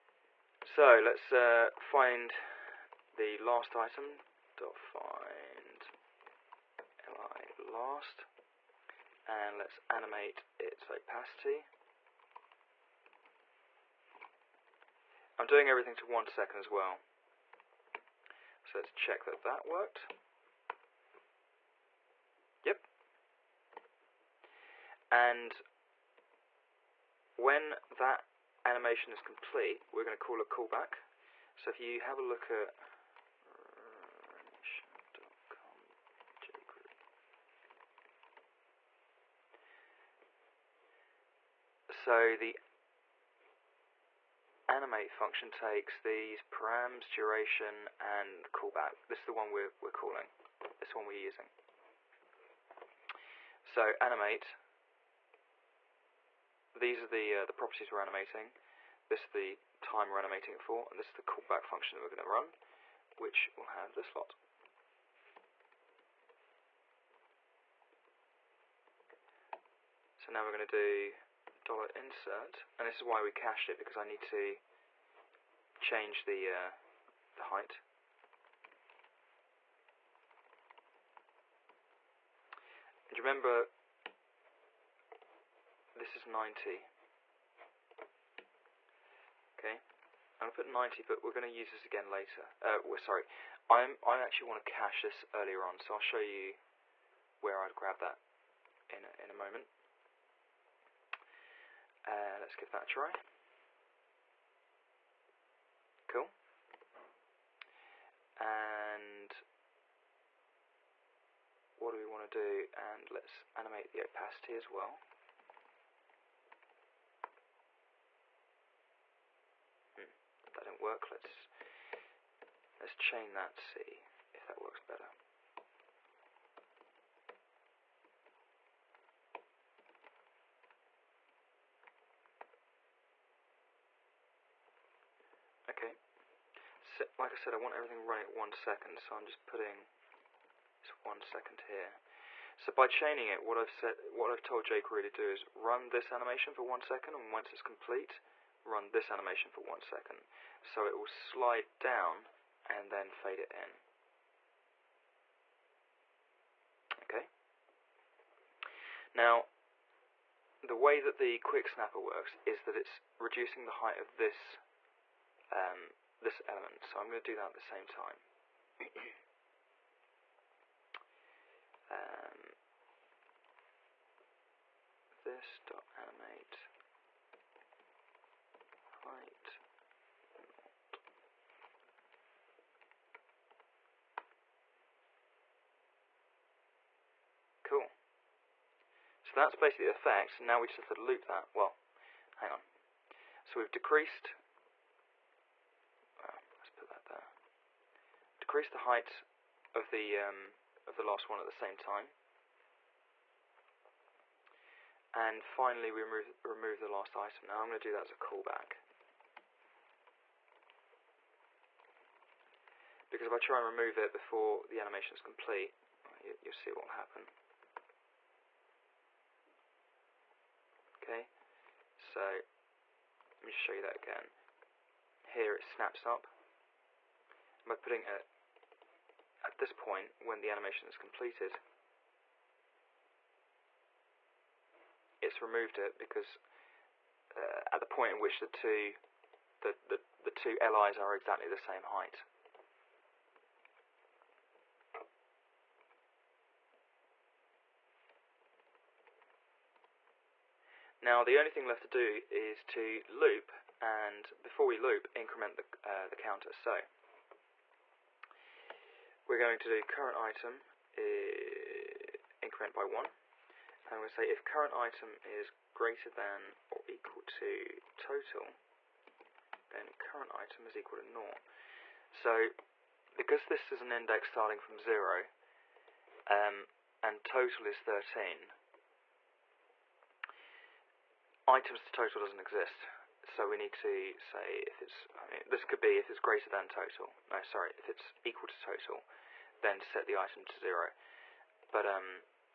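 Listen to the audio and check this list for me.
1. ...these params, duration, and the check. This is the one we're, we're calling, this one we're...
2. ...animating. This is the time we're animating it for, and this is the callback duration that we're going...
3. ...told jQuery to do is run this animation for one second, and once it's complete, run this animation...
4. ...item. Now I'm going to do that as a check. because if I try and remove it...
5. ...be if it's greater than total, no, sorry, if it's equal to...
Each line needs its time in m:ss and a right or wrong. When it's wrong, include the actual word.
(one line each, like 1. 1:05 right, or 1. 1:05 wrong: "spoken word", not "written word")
1. 0:45 wrong: "callback", not "check"
2. 0:58 wrong: "function", not "duration"
3. 2:24 right
4. 3:27 wrong: "callback", not "check"
5. 4:45 right.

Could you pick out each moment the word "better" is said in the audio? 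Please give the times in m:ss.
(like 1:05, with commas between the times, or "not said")
2:04.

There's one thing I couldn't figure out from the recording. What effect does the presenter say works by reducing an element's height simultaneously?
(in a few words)
quick snapper.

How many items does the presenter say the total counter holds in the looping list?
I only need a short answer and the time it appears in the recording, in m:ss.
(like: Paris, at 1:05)
13, at 4:37.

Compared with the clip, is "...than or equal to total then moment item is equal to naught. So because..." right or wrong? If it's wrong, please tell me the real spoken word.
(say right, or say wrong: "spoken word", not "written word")
wrong: "current", not "moment".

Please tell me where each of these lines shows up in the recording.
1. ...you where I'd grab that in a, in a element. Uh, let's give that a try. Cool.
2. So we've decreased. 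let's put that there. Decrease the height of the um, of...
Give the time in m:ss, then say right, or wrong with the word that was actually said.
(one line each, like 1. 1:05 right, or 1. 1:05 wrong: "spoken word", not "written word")
1. 1:36 wrong: "moment", not "element"
2. 3:13 right.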